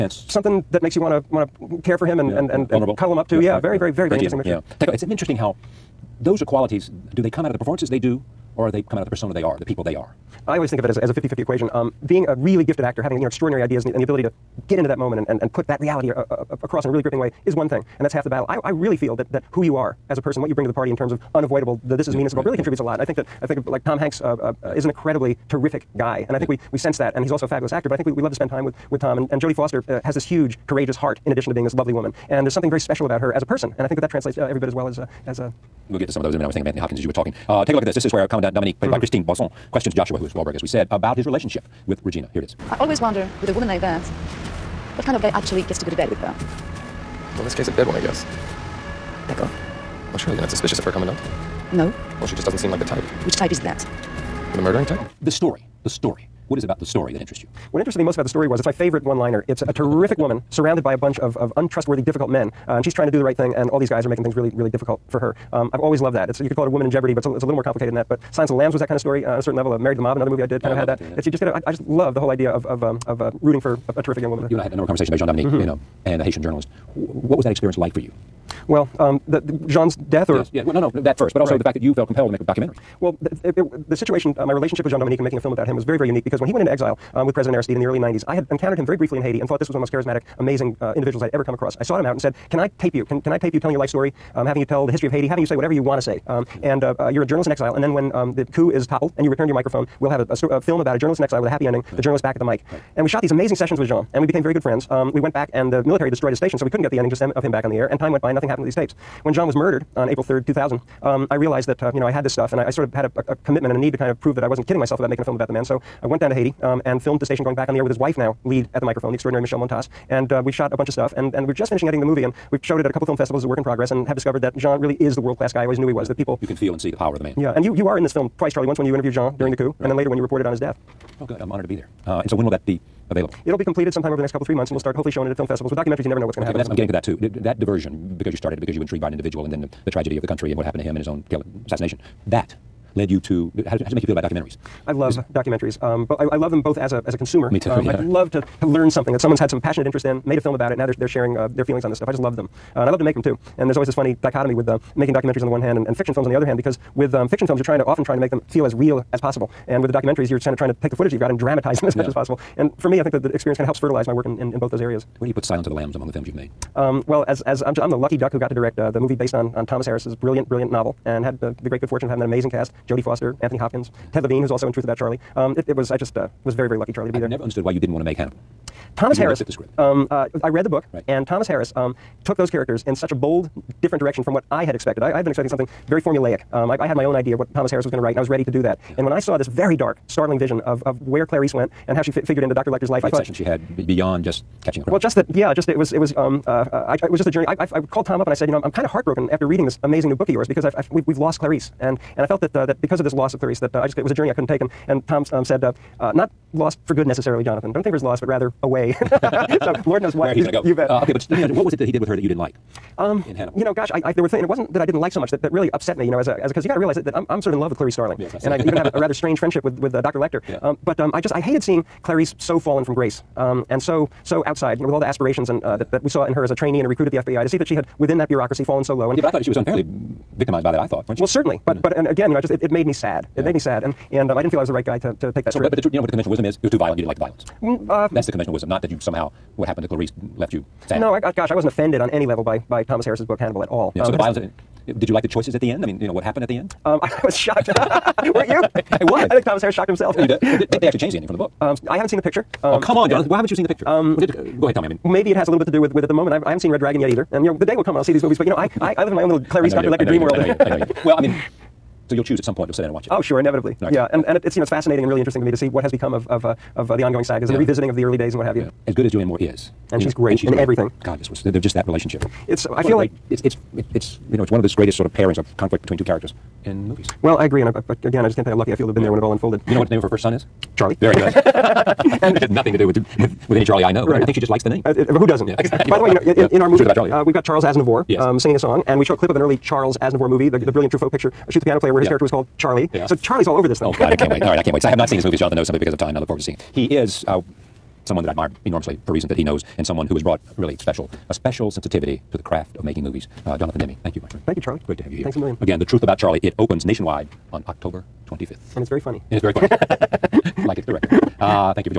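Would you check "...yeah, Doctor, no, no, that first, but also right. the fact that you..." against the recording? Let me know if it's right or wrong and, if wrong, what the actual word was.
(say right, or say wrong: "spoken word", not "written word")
wrong: "Well", not "Doctor".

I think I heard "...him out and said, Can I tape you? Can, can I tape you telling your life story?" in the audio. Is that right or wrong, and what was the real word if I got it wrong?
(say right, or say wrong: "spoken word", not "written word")
right.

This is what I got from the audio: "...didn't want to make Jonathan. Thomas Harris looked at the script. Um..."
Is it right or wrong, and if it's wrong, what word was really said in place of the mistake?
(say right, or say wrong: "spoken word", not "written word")
wrong: "Hannibal", not "Jonathan".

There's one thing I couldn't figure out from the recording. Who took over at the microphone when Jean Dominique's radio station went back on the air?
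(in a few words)
Michelle Montas.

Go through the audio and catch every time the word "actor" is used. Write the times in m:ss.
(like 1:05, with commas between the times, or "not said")
0:12, 0:27.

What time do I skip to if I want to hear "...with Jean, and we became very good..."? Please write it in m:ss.
1:43.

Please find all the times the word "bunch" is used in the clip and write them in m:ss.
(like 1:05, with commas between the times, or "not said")
1:00, 2:00.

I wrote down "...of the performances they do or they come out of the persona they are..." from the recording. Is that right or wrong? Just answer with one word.
right.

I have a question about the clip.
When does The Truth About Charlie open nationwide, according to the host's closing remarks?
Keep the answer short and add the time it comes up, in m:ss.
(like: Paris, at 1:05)
October 25th, at 5:07.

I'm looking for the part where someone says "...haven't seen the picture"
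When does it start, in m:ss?
4:11.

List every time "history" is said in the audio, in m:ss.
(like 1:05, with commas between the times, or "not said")
1:34.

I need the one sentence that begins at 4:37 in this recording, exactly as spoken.
Well, I agree, and I, I, I, again, I just can't tell you how lucky I feel to have been yeah.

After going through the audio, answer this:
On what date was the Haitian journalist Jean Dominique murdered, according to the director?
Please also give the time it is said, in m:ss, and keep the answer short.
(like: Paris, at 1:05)
April 3rd, 2000, at 1:50.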